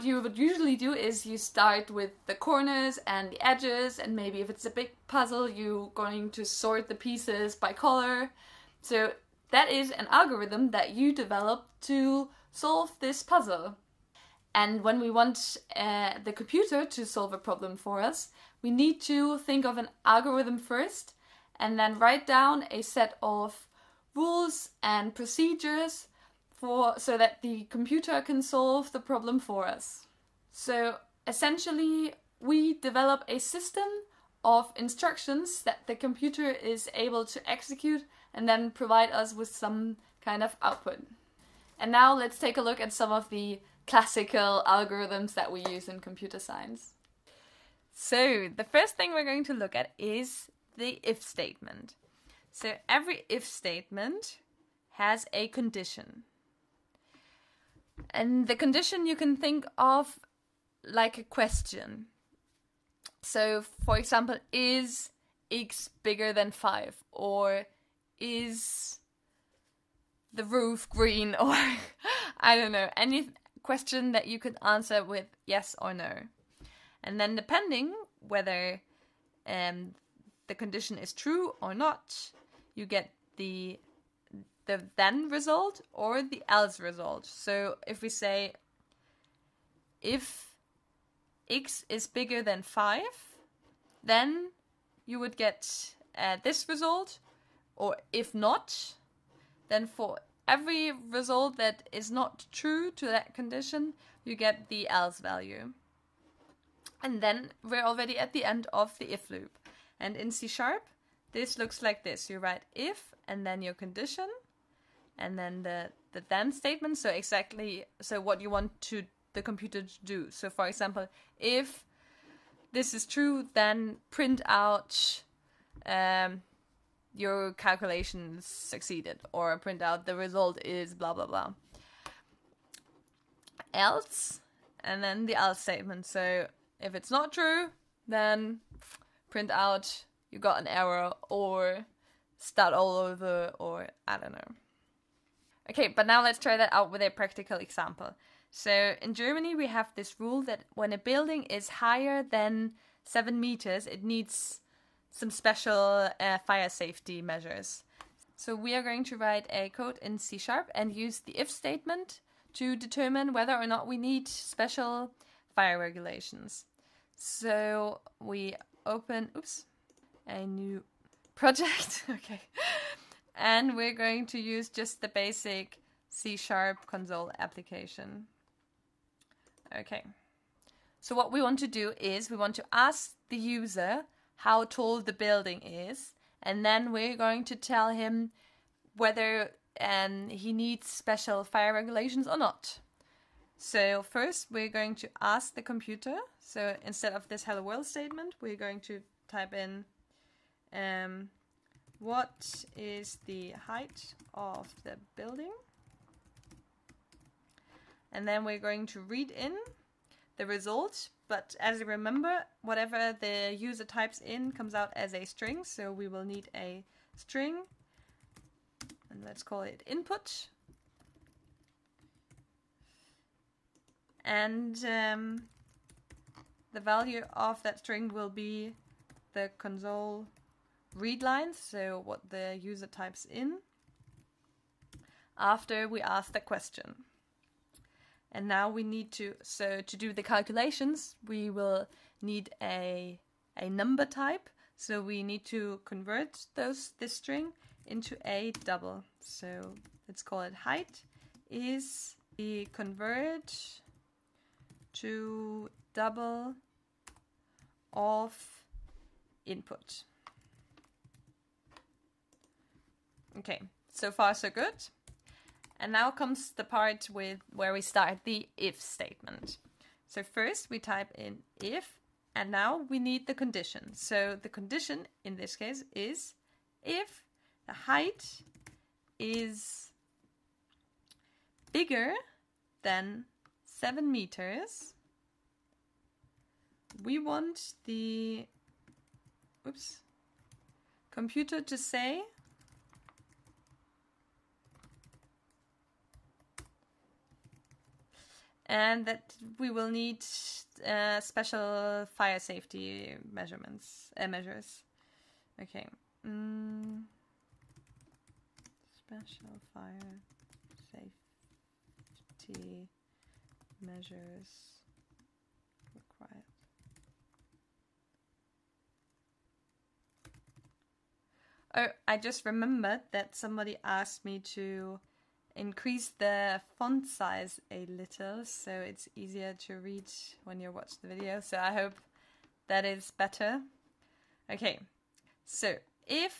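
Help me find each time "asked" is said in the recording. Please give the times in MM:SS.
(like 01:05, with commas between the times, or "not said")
05:23.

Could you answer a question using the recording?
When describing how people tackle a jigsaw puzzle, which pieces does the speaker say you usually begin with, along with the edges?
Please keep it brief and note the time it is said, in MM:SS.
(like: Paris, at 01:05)
Corners, at 00:02.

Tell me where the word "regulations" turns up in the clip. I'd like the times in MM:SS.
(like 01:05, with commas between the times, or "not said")
02:45, 03:11.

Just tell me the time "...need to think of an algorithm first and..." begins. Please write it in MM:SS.
00:18.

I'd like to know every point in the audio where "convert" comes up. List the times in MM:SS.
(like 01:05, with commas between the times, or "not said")
04:05, 04:12.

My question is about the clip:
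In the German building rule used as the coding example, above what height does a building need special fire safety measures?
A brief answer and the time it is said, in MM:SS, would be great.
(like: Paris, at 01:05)
7 meters, at 02:33.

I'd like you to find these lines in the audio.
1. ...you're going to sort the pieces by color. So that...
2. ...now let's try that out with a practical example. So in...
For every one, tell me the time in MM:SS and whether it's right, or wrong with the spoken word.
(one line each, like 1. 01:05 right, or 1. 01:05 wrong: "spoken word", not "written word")
1. 00:05 right
2. 02:26 right.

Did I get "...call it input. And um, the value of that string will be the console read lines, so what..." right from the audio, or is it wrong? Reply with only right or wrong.
right.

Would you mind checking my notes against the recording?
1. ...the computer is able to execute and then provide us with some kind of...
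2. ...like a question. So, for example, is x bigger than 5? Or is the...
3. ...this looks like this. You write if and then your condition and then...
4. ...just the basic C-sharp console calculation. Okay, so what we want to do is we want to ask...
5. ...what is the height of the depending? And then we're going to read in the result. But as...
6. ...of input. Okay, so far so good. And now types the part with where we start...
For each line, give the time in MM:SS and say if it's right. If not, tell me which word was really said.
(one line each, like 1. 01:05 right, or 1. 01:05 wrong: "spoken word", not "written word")
1. 00:35 right
2. 01:00 right
3. 01:51 right
4. 02:54 wrong: "application", not "calculation"
5. 03:21 wrong: "building", not "depending"
6. 04:17 wrong: "comes", not "types".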